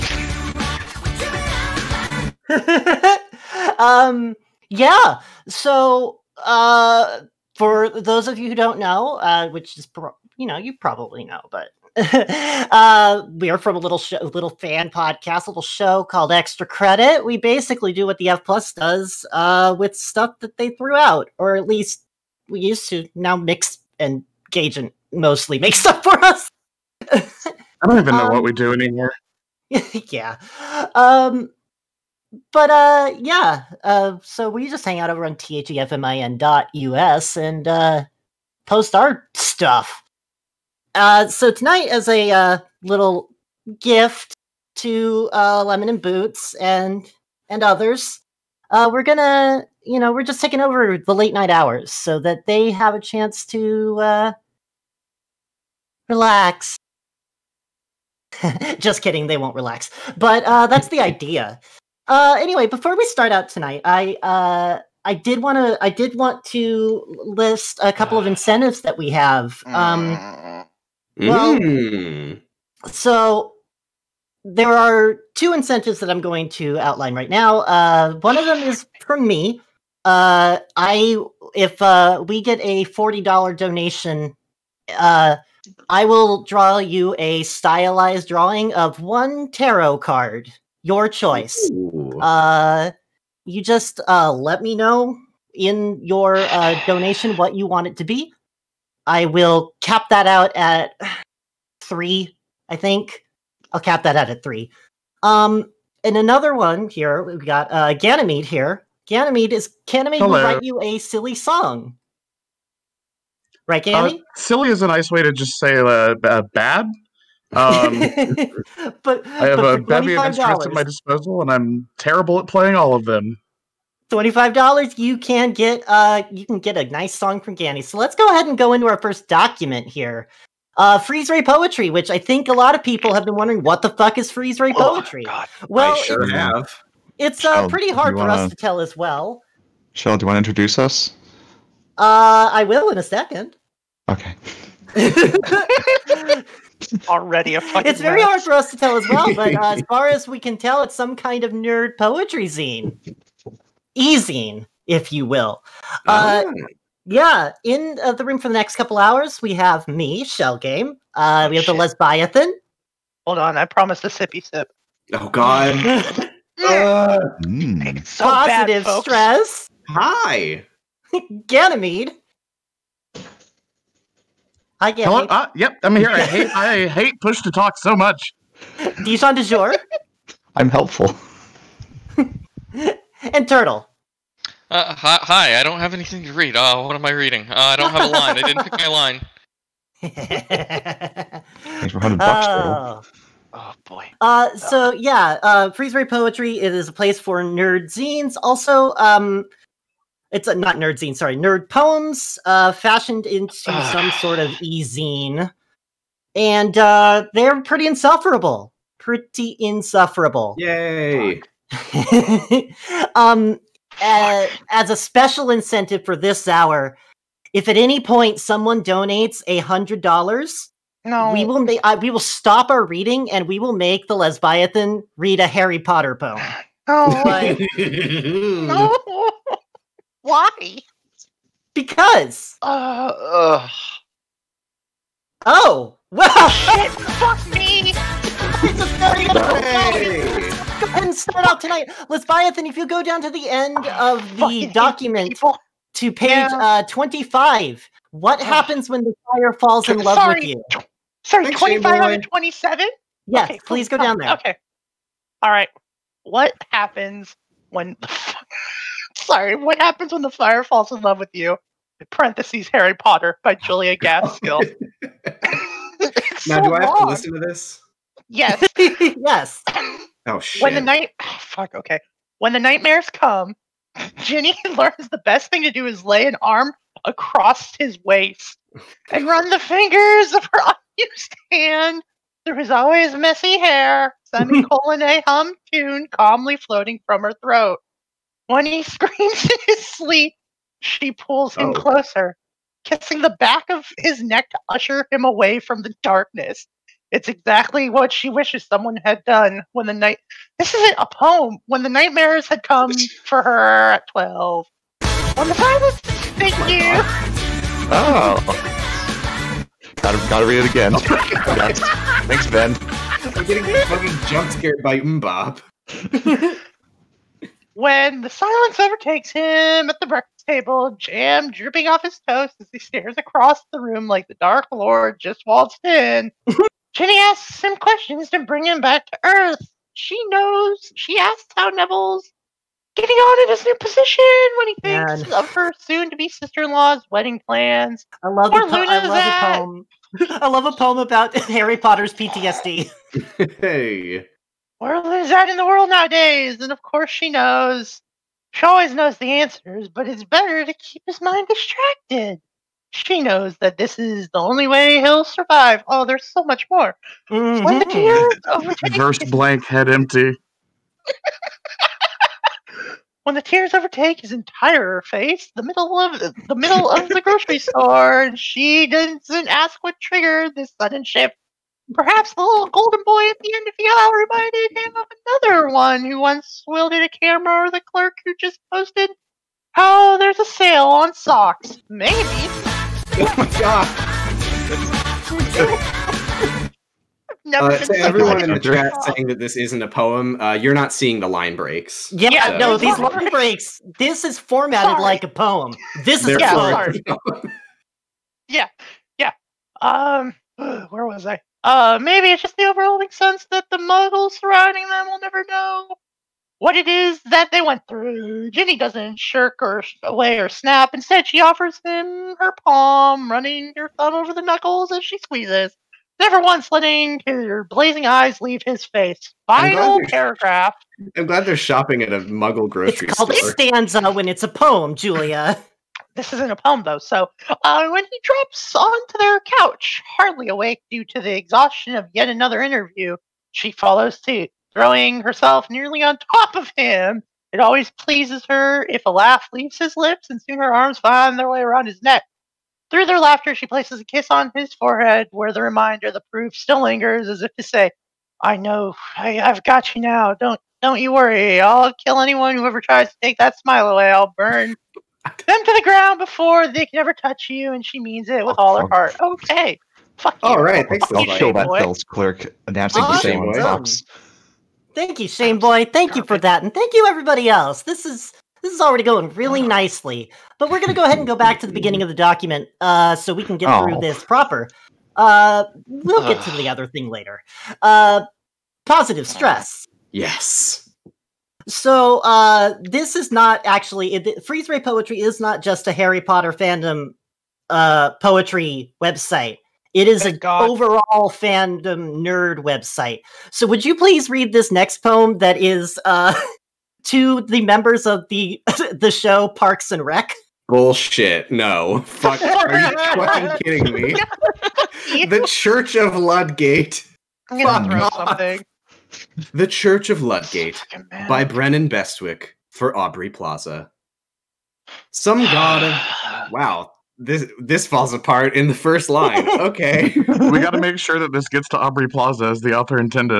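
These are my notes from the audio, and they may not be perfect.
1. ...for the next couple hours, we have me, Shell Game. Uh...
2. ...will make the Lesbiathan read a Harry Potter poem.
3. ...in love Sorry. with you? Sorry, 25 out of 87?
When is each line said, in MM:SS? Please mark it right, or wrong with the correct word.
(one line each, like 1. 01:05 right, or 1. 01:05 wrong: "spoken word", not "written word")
1. 02:38 right
2. 03:43 right
3. 04:09 wrong: "27", not "87".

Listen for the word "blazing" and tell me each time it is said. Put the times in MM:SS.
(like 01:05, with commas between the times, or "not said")
06:57.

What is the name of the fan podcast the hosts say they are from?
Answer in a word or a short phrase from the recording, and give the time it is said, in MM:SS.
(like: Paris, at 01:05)
Extra Credit, at 00:16.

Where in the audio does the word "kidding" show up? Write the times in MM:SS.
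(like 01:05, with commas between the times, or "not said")
00:59, 08:23.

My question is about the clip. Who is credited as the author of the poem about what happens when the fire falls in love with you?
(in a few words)
Julia Gaskill.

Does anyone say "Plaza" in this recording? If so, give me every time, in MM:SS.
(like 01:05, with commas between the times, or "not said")
08:33, 08:42.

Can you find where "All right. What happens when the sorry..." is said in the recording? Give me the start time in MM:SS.
04:15.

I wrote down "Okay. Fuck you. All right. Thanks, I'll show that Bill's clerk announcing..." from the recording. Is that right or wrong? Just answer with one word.
right.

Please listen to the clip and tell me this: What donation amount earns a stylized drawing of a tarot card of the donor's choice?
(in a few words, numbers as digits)
$40.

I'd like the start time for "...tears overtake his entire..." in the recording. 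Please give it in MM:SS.
06:03.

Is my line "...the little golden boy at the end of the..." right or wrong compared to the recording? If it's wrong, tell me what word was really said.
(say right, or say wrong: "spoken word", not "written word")
right.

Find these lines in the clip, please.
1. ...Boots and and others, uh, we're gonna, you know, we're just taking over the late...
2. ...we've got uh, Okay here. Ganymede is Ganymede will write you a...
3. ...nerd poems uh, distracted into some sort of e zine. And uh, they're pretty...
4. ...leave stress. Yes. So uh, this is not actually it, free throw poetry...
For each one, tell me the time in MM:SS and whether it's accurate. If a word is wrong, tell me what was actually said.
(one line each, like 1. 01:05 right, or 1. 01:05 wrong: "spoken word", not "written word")
1. 00:46 right
2. 01:47 wrong: "Ganymede", not "Okay"
3. 03:21 wrong: "fashioned", not "distracted"
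4. 07:58 wrong: "positive", not "leave".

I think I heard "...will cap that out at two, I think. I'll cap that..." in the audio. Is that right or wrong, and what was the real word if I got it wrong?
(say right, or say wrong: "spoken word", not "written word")
wrong: "three", not "two".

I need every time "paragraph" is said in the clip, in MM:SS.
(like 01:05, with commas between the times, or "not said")
07:00.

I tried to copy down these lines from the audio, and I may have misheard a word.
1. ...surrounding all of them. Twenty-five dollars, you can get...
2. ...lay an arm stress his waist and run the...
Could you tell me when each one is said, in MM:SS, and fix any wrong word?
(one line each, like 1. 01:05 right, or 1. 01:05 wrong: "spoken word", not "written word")
1. 02:02 wrong: "playing", not "surrounding"
2. 04:36 wrong: "across", not "stress".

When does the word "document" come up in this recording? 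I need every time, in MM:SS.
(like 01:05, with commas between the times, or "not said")
02:09, 04:04, 07:52.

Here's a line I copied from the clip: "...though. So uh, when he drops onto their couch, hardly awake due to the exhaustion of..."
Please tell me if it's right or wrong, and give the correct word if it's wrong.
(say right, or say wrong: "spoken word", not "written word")
right.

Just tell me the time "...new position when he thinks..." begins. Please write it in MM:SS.
05:33.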